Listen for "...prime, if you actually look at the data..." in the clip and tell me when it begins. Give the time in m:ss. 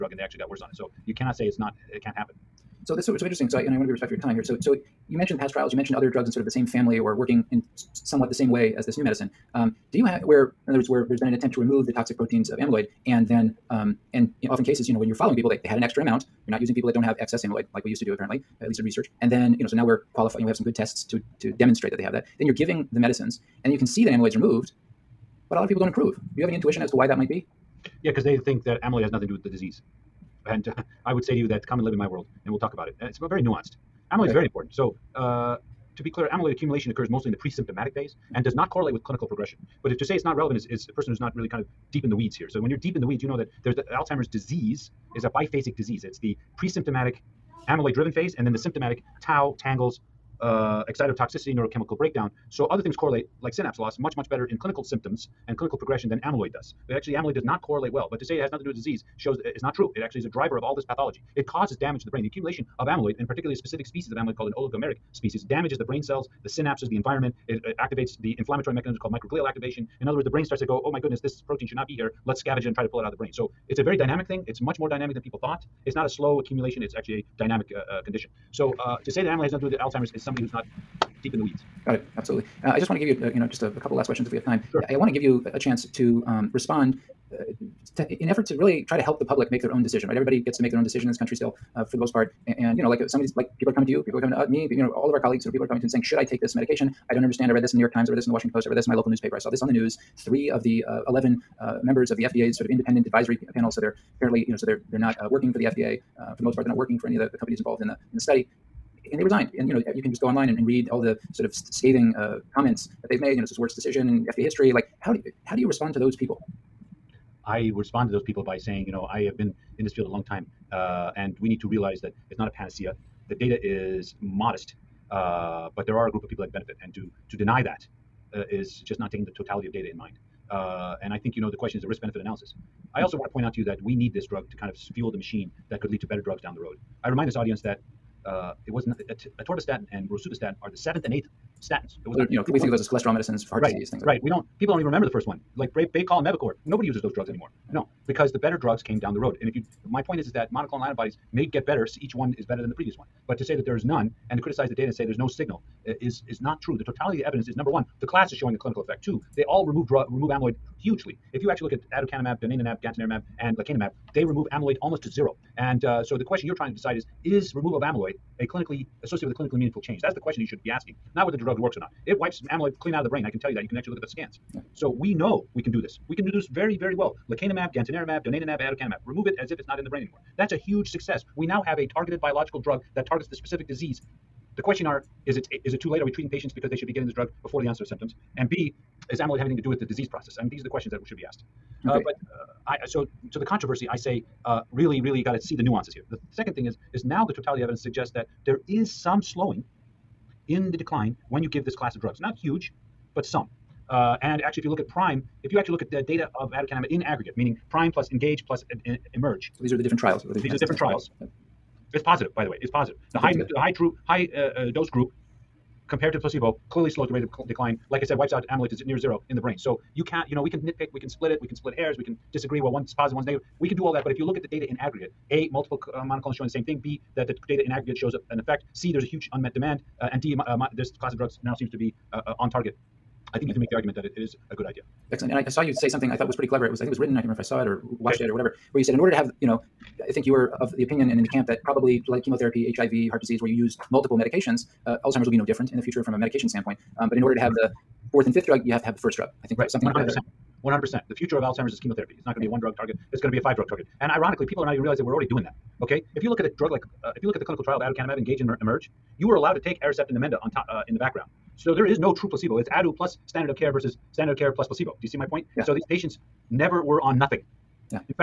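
3:24.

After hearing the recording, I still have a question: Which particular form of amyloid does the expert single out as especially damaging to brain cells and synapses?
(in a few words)
Oligomeric species.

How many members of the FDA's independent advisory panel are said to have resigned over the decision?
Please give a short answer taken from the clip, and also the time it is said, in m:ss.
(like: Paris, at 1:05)
3, at 1:40.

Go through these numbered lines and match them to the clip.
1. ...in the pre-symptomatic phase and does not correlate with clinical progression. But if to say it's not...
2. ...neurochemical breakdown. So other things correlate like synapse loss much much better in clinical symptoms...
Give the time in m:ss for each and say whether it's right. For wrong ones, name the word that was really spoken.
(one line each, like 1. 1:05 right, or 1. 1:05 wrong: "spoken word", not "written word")
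1. 0:37 right
2. 0:51 right.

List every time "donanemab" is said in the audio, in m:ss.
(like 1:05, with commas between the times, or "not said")
2:42, 2:58.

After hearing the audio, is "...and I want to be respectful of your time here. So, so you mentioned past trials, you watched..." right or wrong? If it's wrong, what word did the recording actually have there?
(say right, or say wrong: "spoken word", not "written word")
wrong: "mentioned", not "watched".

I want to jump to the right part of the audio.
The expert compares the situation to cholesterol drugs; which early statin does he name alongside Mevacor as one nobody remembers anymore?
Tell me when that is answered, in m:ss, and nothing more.
2:25.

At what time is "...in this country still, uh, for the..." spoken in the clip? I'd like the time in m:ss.
1:31.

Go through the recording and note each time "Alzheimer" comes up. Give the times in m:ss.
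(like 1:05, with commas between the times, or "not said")
0:43, 1:19, 4:05, 4:11.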